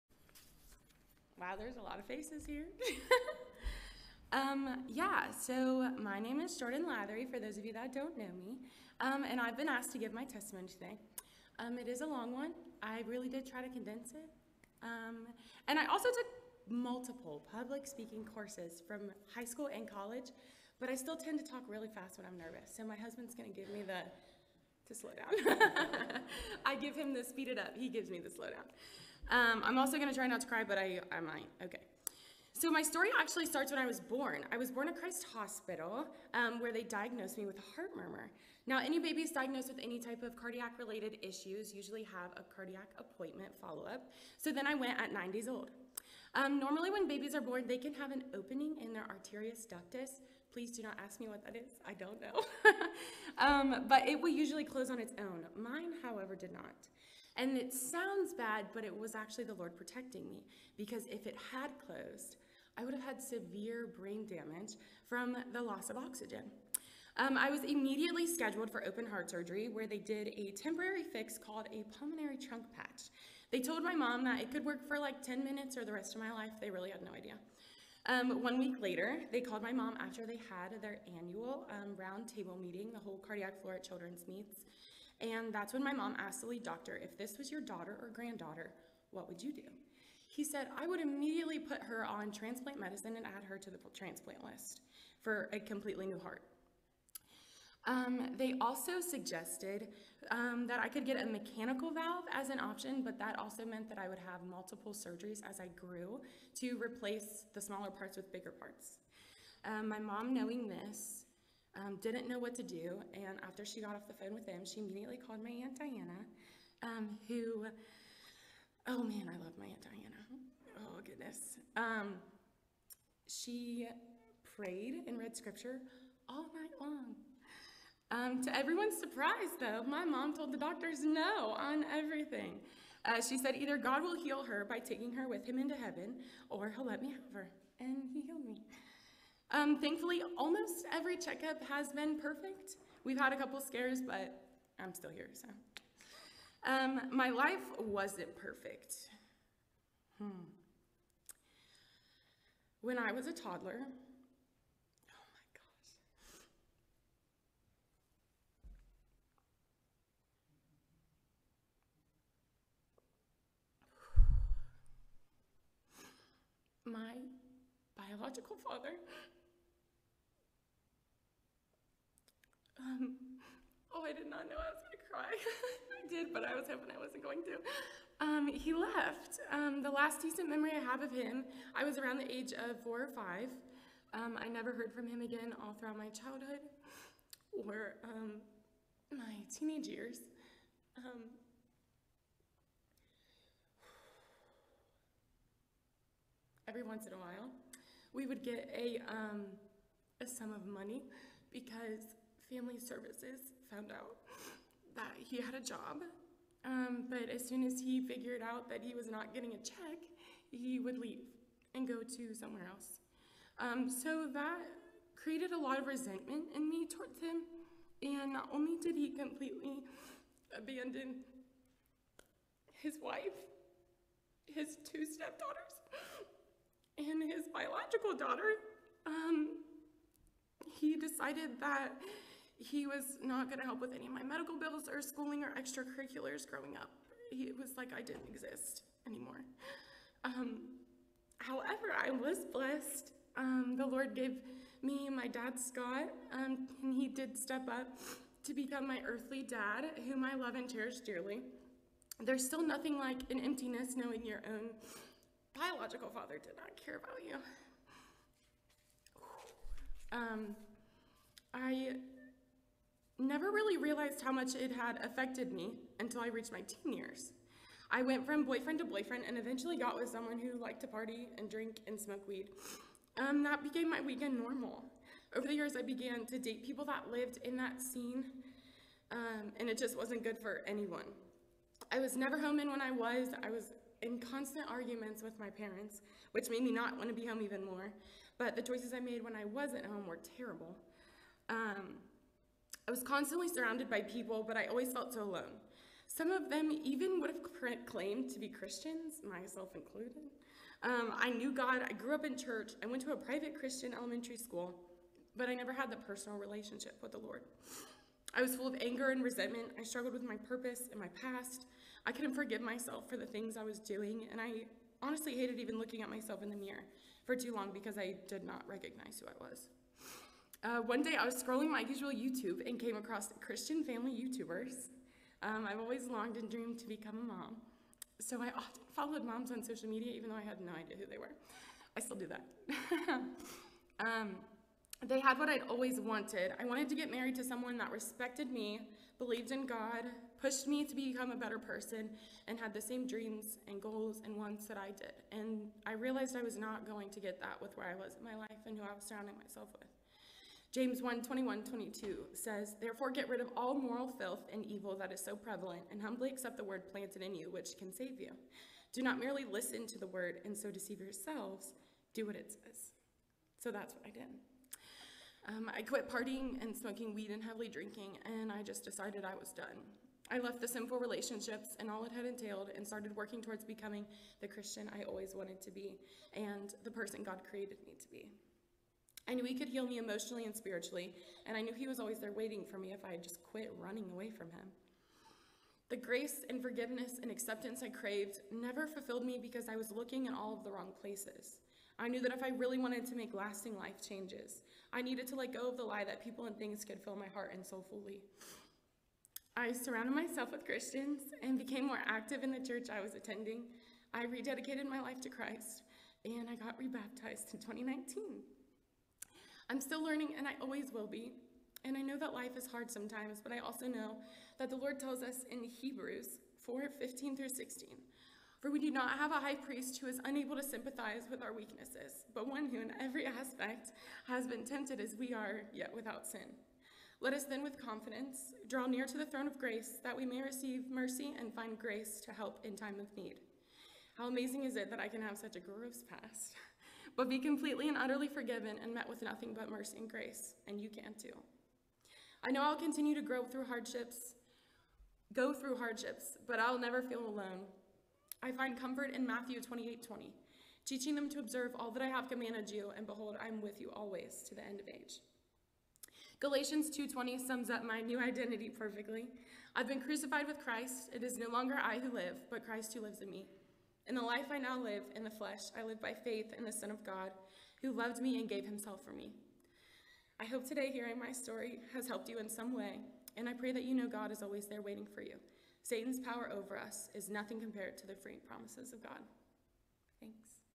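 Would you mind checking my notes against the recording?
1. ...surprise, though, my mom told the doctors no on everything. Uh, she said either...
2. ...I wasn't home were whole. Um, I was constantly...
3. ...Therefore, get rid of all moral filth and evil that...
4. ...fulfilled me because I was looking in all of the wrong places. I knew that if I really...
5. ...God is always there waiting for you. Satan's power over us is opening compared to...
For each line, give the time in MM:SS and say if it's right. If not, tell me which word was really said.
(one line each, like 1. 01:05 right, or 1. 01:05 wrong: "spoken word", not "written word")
1. 02:08 right
2. 04:49 wrong: "terrible", not "whole"
3. 05:52 right
4. 06:28 right
5. 07:54 wrong: "nothing", not "opening".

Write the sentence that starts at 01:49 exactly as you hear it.
Um, my mom, knowing this, um, didn't know what to do.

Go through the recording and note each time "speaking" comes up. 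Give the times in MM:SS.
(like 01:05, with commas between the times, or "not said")
00:17.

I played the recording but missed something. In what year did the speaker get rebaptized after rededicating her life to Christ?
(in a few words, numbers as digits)
2019.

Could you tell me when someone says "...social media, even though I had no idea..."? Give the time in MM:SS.
05:29.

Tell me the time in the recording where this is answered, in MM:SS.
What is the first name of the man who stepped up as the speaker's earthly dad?
04:05.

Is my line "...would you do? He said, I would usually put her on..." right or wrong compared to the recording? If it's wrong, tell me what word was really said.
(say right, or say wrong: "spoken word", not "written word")
wrong: "immediately", not "usually".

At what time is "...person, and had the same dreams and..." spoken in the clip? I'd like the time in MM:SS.
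05:41.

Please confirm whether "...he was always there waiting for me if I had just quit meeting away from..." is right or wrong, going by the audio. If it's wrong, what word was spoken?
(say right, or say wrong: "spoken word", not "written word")
wrong: "running", not "meeting".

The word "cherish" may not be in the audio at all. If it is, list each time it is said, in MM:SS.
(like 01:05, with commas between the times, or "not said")
04:10.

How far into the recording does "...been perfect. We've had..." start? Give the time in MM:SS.
02:21.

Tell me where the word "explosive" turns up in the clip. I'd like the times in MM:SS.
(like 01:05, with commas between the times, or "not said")
not said.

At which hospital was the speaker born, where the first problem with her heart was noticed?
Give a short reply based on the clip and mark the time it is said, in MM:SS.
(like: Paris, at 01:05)
Christ Hospital, at 00:34.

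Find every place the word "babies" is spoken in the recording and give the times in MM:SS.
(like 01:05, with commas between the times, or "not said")
00:38, 00:47.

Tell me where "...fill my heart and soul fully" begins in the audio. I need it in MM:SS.
06:37.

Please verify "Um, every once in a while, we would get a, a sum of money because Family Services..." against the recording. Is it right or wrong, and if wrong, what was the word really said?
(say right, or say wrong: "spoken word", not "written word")
right.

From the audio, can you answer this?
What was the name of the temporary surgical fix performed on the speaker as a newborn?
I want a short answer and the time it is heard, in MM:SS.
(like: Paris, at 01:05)
pulmonary trunk patch, at 01:11.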